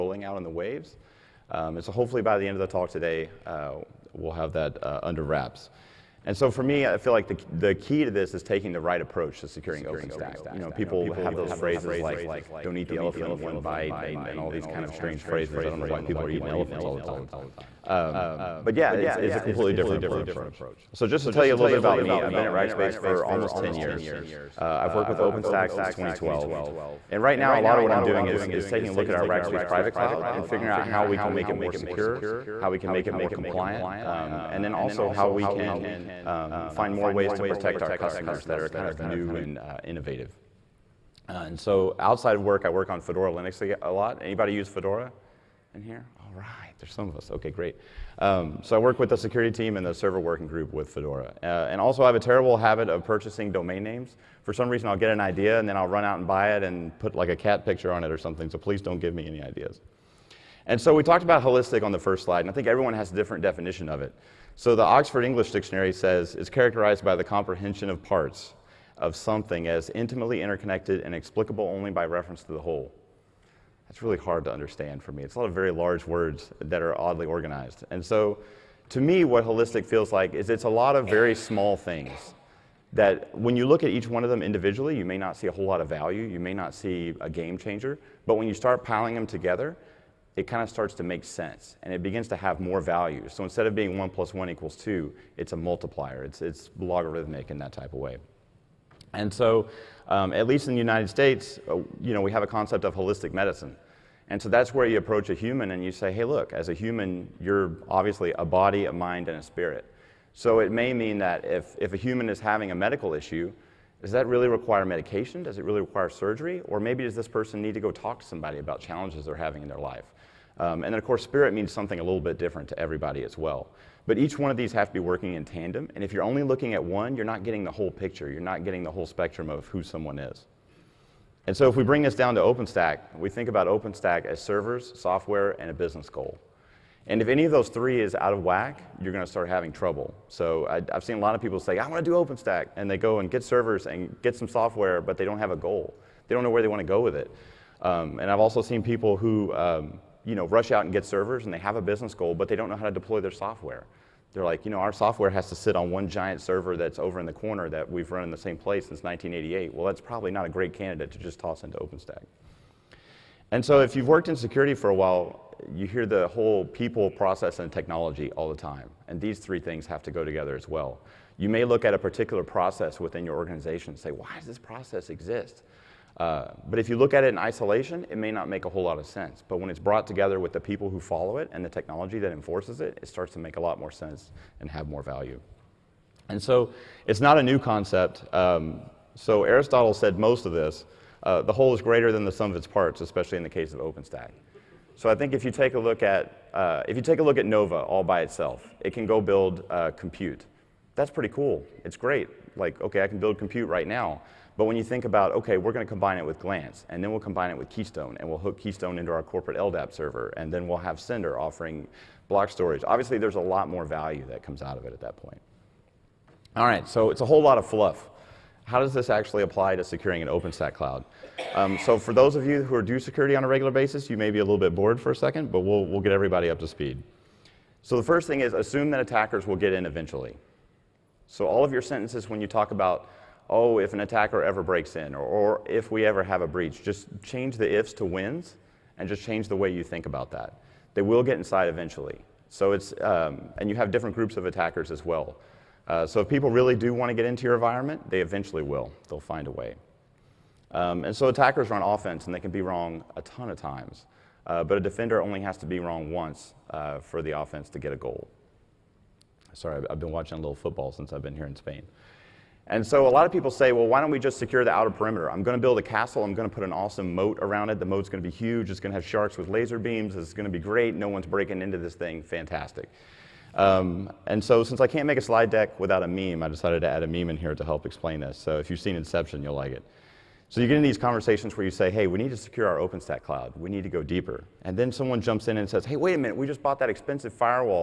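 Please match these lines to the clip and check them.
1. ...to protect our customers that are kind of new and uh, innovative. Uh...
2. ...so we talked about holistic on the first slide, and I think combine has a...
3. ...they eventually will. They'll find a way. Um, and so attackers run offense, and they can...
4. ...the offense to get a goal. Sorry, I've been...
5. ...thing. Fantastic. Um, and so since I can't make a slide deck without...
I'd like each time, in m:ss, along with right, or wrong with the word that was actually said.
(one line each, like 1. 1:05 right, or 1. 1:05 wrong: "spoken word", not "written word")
1. 0:37 right
2. 1:00 wrong: "everyone", not "combine"
3. 4:08 right
4. 4:17 right
5. 4:31 right.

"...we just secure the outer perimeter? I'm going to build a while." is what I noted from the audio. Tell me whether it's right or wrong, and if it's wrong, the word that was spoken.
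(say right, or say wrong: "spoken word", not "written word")
wrong: "castle", not "while".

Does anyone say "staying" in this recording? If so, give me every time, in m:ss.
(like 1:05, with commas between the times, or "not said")
not said.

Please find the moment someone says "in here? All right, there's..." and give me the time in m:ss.
0:45.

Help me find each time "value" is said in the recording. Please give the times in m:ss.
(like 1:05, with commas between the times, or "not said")
1:25, 1:32, 3:05, 3:33.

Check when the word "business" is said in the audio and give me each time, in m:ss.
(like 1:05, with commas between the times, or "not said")
2:15, 2:31.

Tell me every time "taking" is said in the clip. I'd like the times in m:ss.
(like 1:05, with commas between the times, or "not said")
0:08, 0:28.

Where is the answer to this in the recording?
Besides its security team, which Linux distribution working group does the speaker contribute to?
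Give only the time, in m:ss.
0:49.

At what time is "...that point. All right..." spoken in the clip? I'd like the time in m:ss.
3:35.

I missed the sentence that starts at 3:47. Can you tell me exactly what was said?
So the first thing is assume that attackers will get in eventually.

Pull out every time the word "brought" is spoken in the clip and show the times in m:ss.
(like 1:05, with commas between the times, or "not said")
2:59.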